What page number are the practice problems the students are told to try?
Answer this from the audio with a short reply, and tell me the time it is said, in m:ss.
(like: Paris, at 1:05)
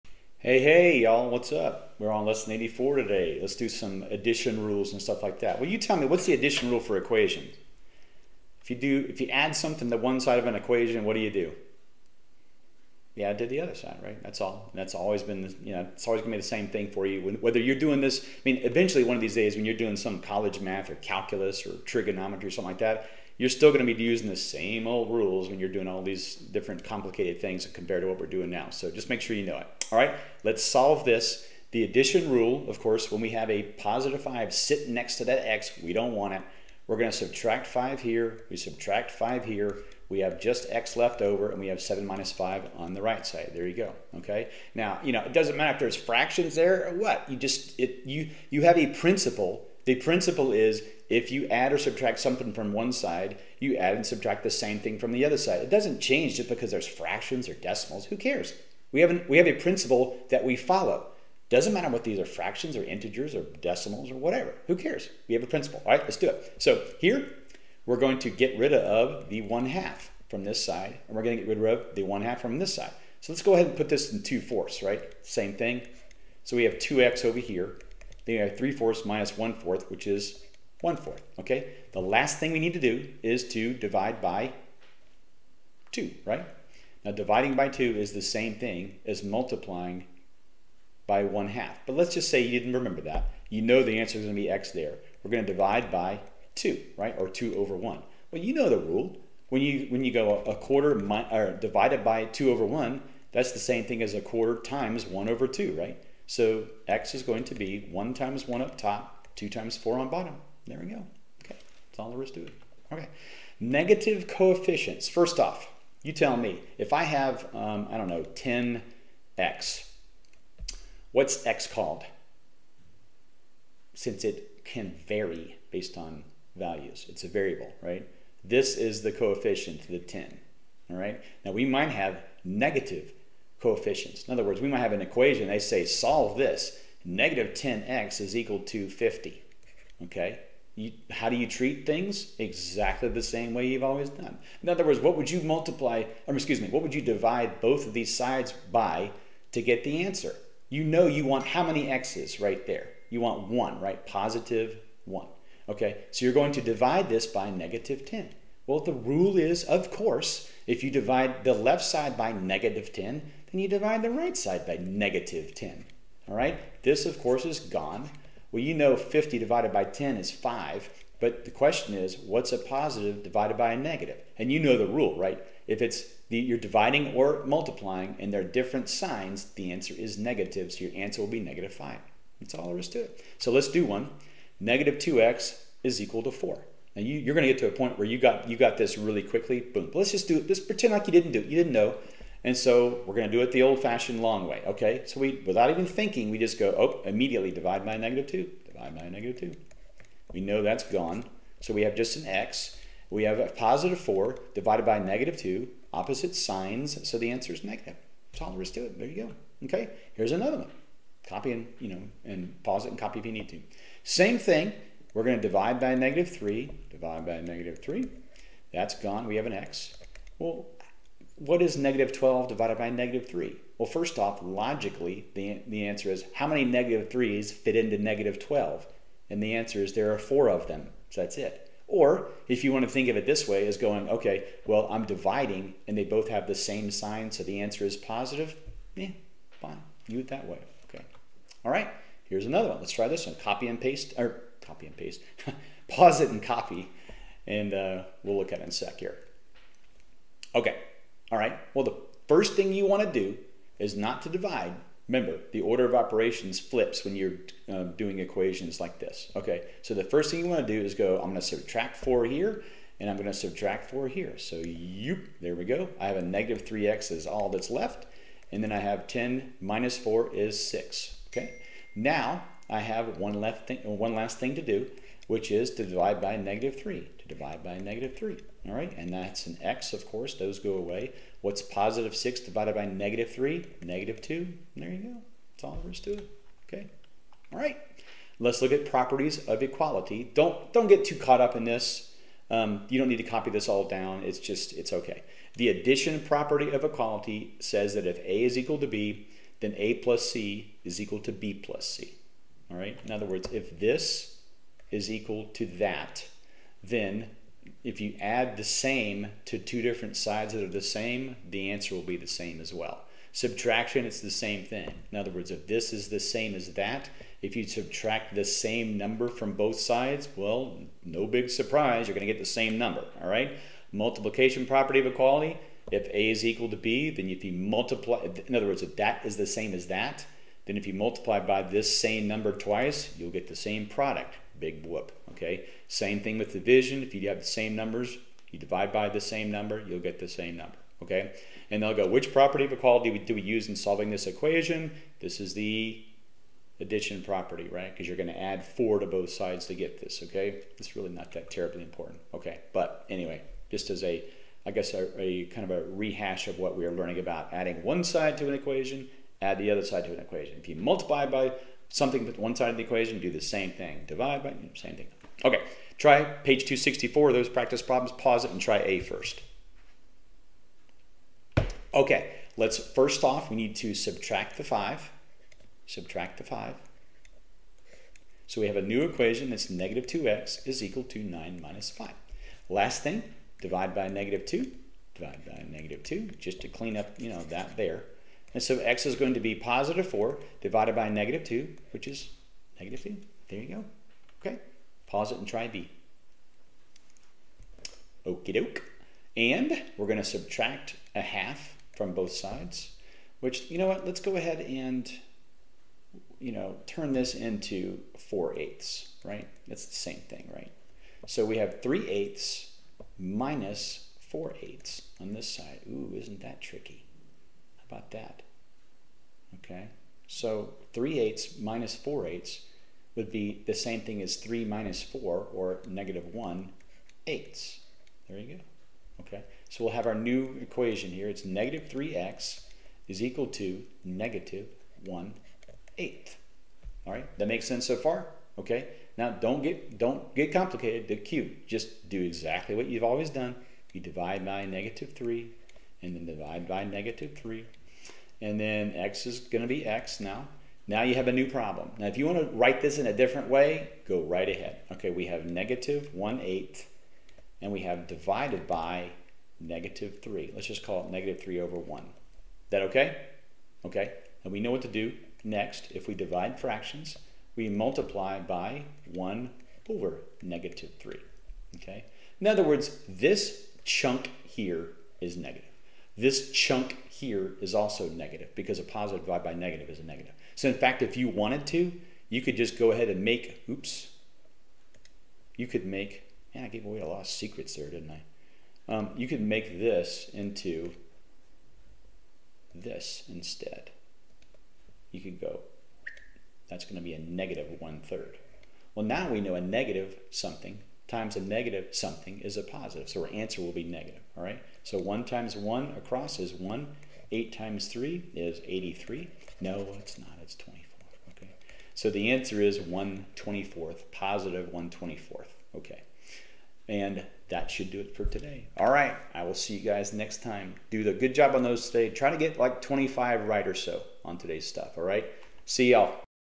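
264, at 6:06.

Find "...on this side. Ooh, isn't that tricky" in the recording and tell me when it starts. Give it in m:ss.
6:55.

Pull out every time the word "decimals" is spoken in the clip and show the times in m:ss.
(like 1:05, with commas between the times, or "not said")
0:57, 1:03.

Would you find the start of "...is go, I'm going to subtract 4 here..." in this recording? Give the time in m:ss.
4:20.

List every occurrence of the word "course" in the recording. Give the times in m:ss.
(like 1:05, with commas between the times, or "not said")
0:32, 2:39, 2:47, 4:40.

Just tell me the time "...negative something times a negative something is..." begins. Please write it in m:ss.
8:19.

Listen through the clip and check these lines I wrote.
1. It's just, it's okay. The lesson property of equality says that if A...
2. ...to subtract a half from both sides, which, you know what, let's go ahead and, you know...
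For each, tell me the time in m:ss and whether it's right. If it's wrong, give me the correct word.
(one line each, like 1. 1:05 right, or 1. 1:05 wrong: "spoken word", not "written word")
1. 4:54 wrong: "addition", not "lesson"
2. 6:40 right.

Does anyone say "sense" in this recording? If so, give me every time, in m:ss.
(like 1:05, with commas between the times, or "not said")
7:17.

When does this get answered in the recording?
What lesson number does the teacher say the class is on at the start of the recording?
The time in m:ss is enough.
0:02.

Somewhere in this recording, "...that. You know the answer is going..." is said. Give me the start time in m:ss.
1:33.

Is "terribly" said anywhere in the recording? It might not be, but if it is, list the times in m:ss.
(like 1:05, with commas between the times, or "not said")
5:51.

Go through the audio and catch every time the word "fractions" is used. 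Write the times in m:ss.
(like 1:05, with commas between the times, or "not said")
0:45, 0:56, 1:02, 7:46.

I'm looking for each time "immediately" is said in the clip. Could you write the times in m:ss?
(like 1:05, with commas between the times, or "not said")
3:17.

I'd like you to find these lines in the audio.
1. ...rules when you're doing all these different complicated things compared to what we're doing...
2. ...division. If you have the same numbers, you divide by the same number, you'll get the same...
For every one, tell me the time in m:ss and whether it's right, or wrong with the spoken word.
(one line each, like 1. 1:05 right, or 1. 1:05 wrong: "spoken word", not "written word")
1. 0:25 right
2. 5:36 right.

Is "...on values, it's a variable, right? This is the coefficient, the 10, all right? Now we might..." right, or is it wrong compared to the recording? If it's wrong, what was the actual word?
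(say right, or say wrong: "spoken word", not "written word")
right.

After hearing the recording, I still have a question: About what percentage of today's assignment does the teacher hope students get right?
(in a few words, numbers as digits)
25.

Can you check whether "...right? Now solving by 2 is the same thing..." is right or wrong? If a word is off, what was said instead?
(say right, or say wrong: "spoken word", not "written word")
wrong: "dividing", not "solving".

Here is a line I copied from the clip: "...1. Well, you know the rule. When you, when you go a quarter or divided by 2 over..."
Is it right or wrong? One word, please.
right.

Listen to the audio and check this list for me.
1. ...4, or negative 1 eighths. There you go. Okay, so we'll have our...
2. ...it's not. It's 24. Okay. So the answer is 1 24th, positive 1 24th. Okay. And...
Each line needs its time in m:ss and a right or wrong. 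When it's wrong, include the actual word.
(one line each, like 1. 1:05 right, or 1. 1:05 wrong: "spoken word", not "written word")
1. 7:05 right
2. 8:29 right.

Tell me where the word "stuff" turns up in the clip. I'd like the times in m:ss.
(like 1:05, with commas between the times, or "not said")
0:04, 8:44.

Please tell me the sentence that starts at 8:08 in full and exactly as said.
Um, you could make this into this instead.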